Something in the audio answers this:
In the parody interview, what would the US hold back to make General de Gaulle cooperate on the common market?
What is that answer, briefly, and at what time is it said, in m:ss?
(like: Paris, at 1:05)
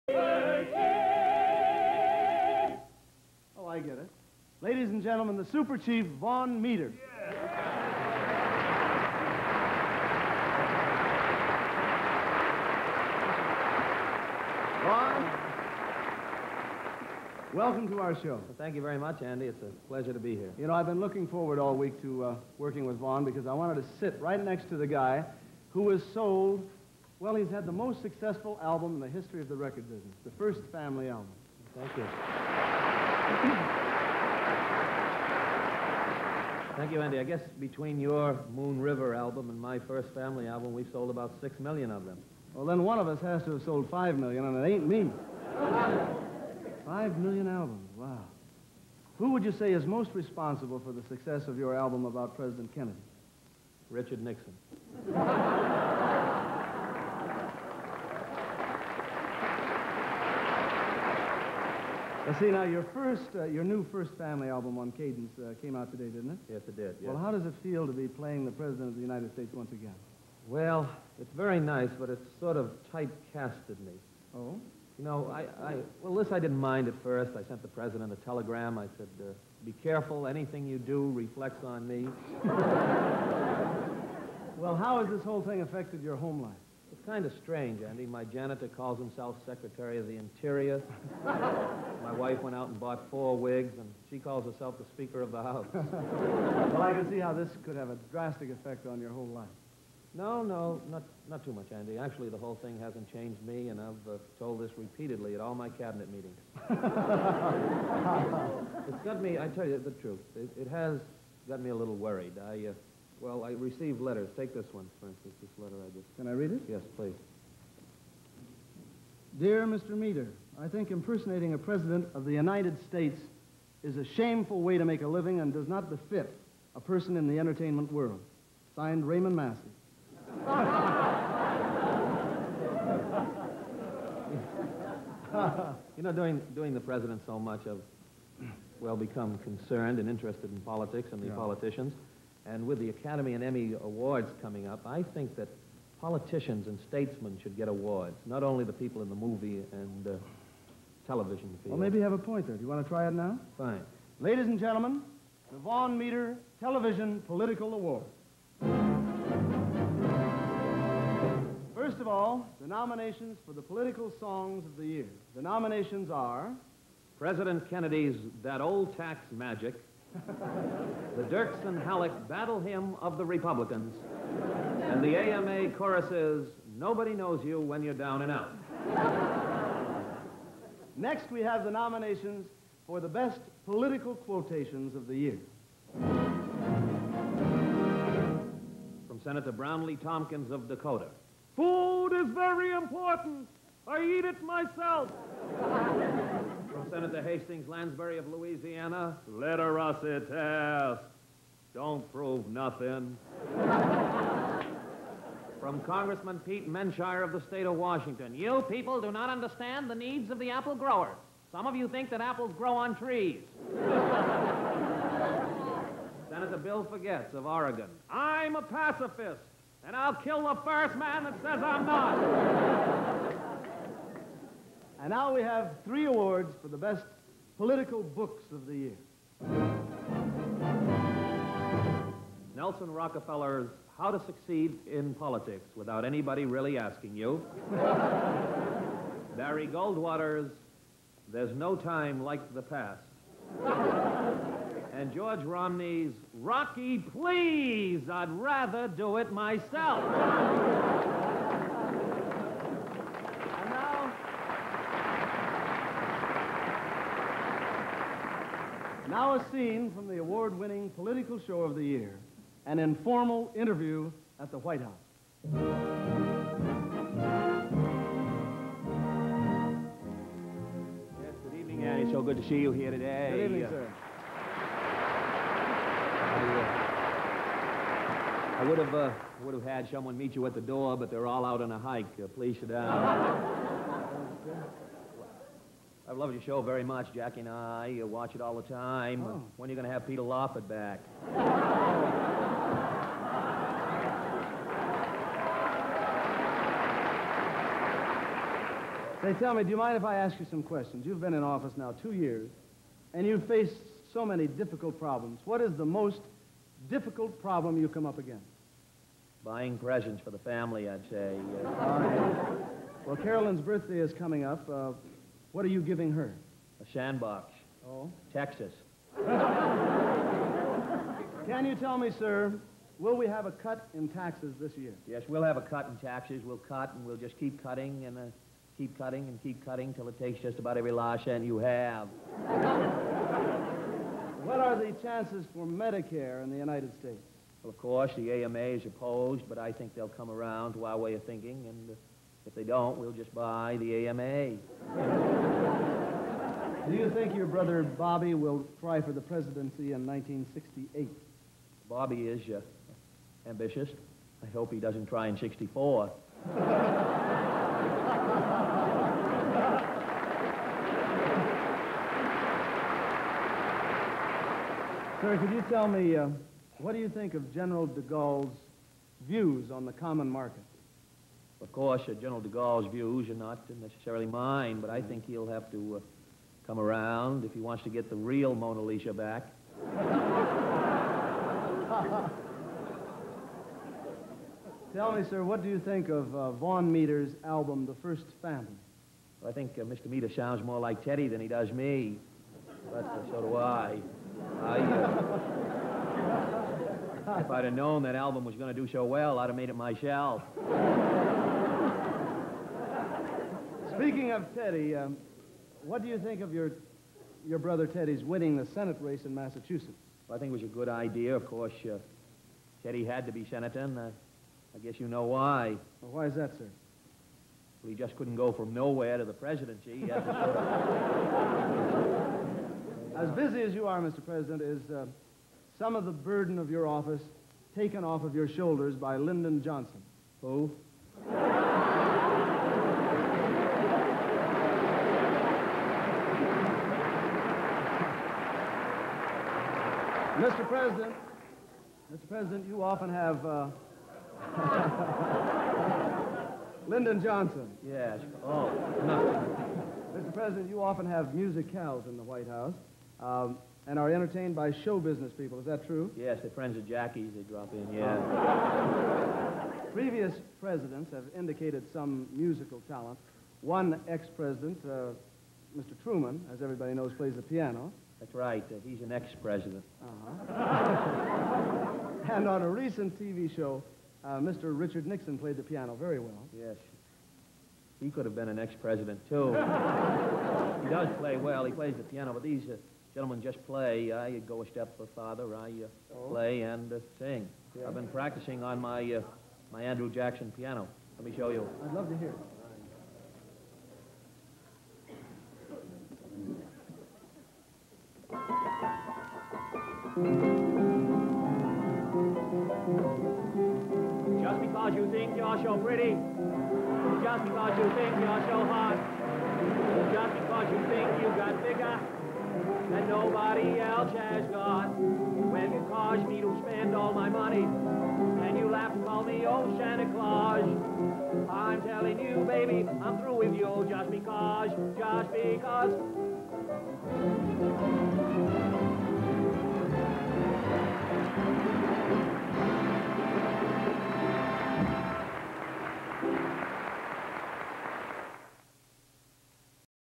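the real Mona Lisa, at 6:18.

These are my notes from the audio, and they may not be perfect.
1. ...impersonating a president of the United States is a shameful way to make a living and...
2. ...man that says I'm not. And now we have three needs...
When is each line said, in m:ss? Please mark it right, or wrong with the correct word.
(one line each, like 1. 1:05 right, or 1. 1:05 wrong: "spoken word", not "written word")
1. 2:00 right
2. 3:40 wrong: "awards", not "needs".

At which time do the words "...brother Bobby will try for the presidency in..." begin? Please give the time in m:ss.
5:47.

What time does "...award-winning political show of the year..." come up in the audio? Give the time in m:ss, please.
4:20.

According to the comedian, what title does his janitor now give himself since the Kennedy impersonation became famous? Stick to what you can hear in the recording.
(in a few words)
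Secretary of the Interior.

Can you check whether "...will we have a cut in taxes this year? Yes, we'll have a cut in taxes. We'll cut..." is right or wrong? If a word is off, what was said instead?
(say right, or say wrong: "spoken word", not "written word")
right.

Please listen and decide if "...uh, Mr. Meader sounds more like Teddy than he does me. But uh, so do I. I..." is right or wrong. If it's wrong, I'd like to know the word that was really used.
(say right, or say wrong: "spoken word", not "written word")
right.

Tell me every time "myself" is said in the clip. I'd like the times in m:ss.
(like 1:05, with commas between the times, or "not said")
3:14, 4:09, 6:39.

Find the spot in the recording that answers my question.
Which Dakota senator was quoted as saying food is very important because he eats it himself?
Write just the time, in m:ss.
3:09.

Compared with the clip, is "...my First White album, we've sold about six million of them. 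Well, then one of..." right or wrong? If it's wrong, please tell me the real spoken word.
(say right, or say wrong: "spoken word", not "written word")
wrong: "Family", not "White".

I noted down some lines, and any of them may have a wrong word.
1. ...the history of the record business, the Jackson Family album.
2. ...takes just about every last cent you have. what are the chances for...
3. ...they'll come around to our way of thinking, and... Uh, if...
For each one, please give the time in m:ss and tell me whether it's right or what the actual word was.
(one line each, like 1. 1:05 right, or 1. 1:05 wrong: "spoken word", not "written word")
1. 0:29 wrong: "First", not "Jackson"
2. 5:30 right
3. 5:39 right.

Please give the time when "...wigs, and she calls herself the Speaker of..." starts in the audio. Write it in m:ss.
1:33.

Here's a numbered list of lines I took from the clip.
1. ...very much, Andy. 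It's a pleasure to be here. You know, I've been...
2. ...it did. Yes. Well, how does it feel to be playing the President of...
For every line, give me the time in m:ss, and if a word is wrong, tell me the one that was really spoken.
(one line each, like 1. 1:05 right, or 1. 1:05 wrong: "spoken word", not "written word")
1. 0:18 right
2. 1:06 right.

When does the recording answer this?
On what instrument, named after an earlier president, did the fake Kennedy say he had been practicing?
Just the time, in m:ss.
8:09.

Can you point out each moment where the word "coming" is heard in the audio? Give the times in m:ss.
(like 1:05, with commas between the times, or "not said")
2:24, 5:14.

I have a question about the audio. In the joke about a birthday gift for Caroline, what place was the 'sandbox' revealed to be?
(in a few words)
Texas.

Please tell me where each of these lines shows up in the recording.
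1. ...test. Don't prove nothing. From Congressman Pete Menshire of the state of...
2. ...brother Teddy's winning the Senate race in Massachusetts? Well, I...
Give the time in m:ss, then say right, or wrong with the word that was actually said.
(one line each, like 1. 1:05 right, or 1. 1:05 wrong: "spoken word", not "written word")
1. 3:20 right
2. 6:47 right.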